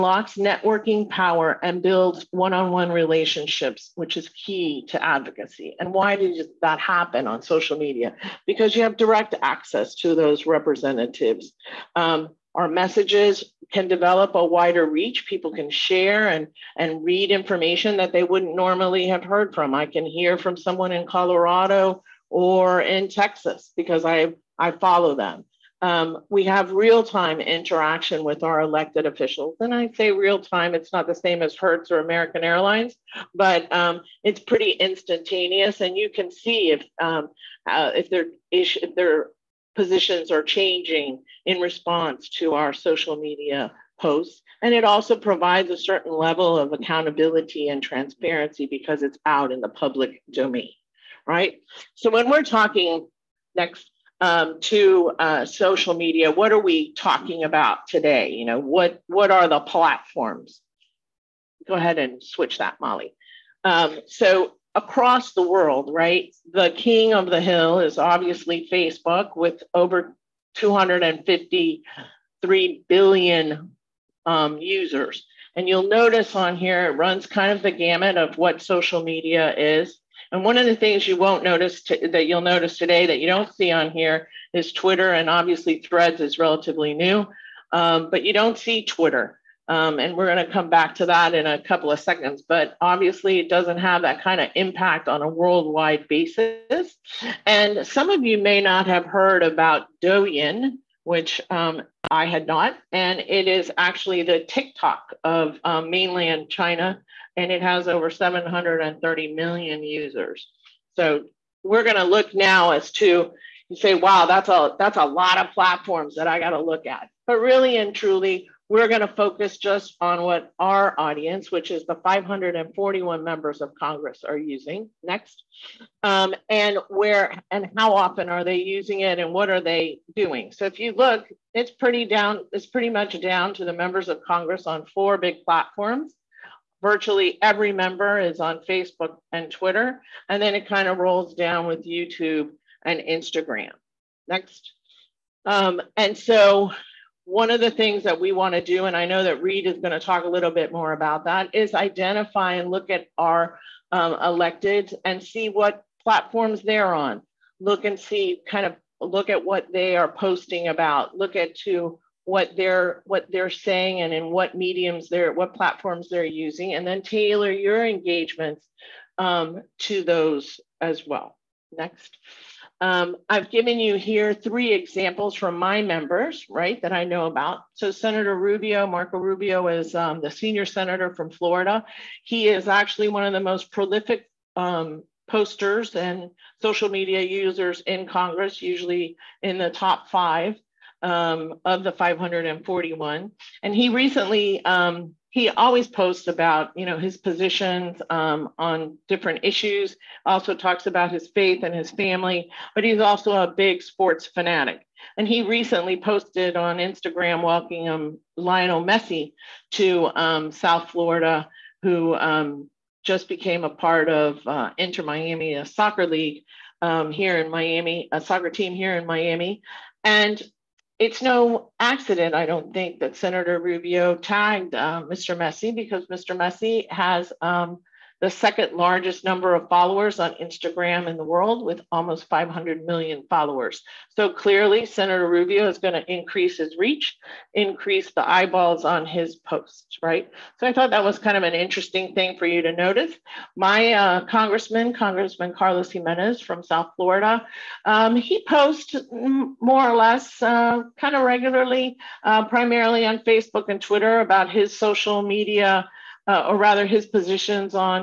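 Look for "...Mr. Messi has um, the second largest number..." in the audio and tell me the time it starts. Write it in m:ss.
3:46.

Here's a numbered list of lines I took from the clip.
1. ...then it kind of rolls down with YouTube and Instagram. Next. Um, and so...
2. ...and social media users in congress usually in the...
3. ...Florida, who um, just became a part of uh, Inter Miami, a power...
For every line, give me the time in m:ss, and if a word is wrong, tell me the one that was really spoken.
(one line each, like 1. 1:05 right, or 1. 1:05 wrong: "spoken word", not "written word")
1. 2:20 right
2. 3:05 right
3. 3:30 wrong: "soccer", not "power".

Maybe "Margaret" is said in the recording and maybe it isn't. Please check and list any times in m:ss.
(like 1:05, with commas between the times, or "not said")
not said.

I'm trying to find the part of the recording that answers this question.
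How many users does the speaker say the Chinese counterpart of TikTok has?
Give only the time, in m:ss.
1:48.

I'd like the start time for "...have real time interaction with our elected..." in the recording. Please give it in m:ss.
0:26.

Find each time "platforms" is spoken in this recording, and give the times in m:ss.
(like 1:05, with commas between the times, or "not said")
0:59, 1:55, 2:15, 2:36, 2:45.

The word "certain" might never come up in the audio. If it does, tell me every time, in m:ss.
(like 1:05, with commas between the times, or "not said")
0:45.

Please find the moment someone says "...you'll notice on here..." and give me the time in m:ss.
1:15.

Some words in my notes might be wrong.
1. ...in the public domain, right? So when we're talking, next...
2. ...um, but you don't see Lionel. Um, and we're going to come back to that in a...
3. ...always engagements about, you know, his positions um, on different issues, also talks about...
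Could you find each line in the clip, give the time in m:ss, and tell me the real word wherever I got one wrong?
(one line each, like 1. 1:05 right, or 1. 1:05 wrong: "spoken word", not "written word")
1. 0:49 right
2. 1:27 wrong: "Twitter", not "Lionel"
3. 3:15 wrong: "posts", not "engagements".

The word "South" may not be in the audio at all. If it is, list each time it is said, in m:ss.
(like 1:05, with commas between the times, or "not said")
3:30, 4:06.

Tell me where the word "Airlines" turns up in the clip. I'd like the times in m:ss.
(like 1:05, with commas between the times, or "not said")
0:32.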